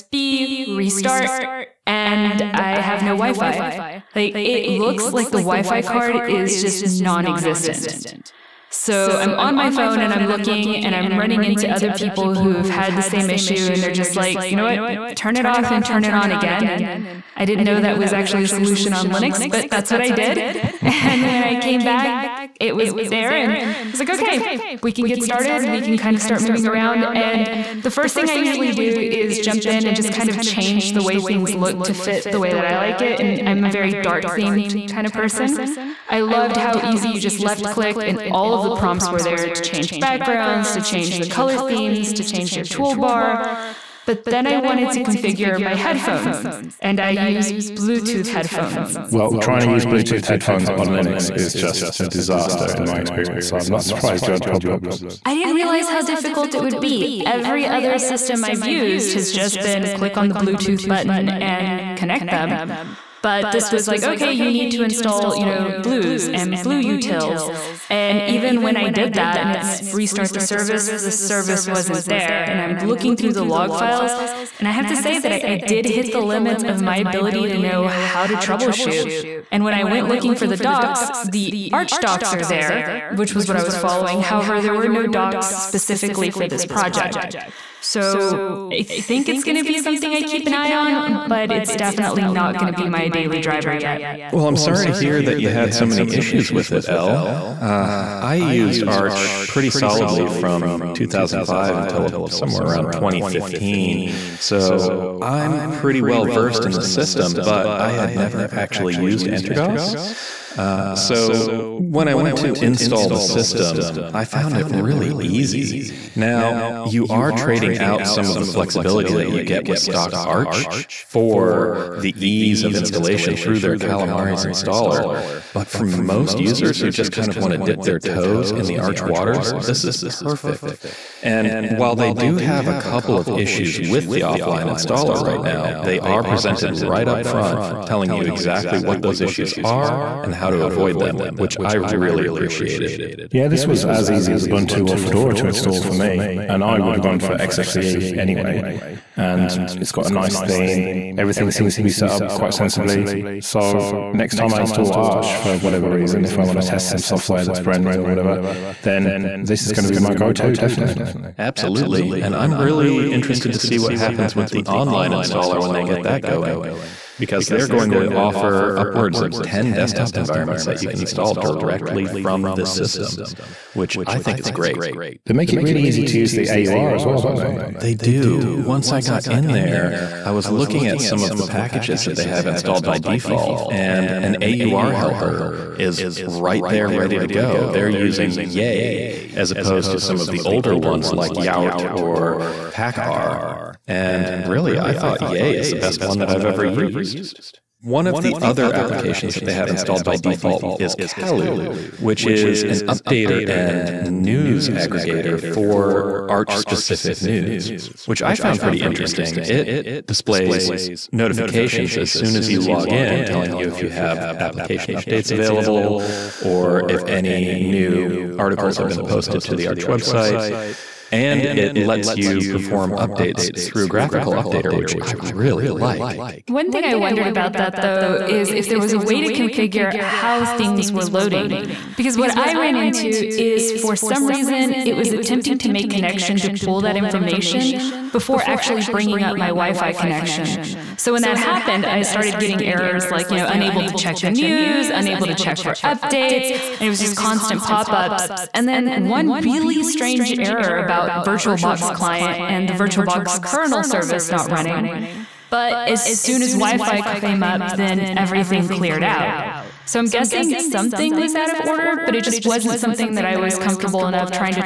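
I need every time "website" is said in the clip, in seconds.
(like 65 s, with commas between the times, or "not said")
219 s.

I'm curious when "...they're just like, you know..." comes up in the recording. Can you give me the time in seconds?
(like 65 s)
13 s.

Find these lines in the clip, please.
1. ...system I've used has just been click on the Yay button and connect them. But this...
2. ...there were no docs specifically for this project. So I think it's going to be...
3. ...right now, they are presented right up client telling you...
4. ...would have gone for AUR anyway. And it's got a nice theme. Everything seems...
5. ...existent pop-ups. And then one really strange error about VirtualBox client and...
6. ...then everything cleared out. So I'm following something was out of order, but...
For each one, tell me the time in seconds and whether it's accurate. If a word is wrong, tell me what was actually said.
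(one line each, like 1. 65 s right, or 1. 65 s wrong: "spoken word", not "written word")
1. 57 s wrong: "Bluetooth", not "Yay"
2. 84 s right
3. 135 s wrong: "front", not "client"
4. 146 s wrong: "XFCE", not "AUR"
5. 247 s wrong: "constant", not "existent"
6. 257 s wrong: "guessing", not "following".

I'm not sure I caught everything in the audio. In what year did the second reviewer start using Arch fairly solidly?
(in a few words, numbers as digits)
2005.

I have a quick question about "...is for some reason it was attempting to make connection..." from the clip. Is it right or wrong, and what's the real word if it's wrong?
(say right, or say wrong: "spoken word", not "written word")
right.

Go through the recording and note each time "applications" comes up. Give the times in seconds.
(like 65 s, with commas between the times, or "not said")
198 s, 214 s.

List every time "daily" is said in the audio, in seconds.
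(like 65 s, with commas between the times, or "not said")
93 s.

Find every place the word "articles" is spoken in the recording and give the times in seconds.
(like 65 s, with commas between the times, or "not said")
218 s.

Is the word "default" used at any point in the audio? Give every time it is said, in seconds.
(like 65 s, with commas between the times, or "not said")
182 s, 200 s.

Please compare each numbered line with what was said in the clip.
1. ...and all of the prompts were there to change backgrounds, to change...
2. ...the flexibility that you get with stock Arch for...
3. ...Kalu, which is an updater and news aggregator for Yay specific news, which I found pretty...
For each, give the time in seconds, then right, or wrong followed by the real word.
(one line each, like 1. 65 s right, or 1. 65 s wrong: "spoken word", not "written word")
1. 38 s right
2. 118 s right
3. 200 s wrong: "Arch", not "Yay".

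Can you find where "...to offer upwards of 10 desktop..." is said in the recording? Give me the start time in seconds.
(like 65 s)
167 s.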